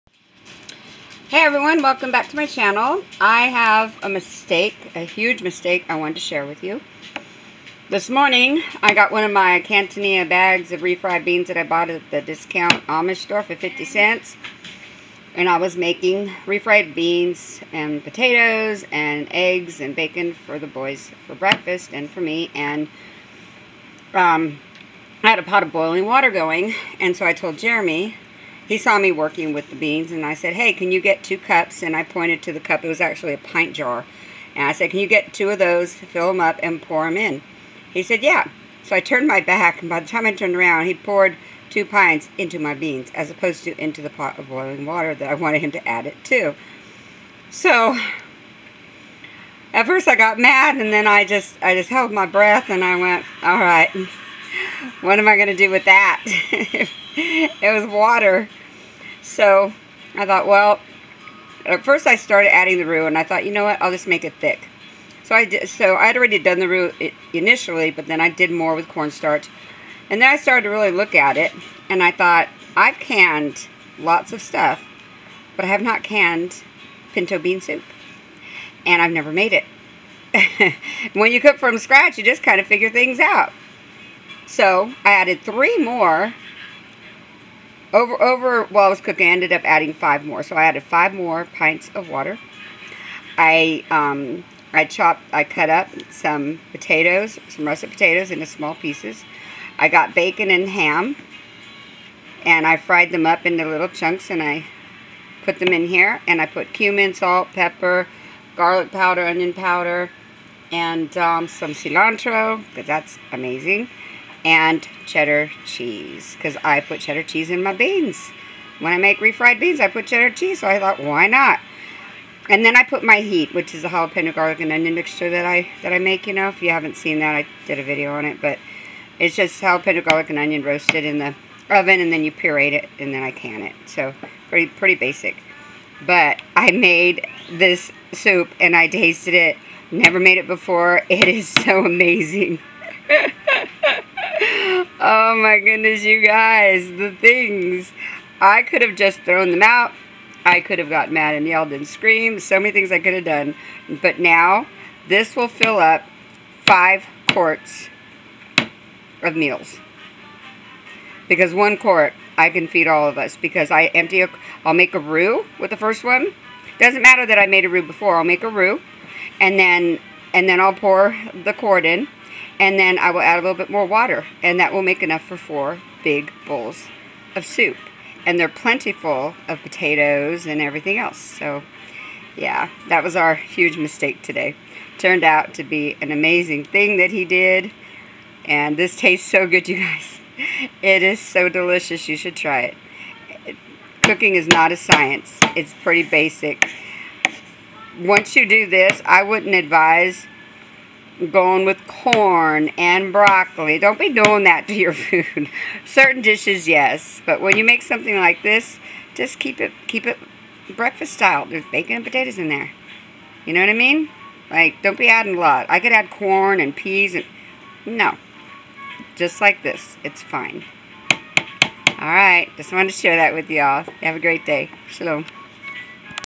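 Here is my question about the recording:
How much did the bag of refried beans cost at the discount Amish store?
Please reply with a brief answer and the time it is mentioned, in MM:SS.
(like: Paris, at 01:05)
50 cents, at 00:13.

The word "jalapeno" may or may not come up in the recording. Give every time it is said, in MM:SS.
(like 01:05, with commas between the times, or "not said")
02:03, 02:09.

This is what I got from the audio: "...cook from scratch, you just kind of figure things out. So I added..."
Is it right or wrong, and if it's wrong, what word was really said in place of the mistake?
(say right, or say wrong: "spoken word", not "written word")
right.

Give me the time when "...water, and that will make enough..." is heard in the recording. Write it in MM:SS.
02:53.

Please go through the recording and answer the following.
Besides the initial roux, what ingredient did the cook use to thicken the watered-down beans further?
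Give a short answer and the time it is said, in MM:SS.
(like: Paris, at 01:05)
Cornstarch, at 01:08.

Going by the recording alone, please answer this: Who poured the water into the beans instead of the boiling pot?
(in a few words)
Jeremy.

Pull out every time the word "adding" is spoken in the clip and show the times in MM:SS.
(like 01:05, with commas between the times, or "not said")
01:02, 01:29, 03:35.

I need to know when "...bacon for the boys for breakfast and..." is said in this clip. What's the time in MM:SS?
00:19.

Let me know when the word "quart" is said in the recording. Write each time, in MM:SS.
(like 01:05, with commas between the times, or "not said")
02:37, 02:41, 02:51.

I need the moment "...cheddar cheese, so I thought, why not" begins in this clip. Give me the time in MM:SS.
02:00.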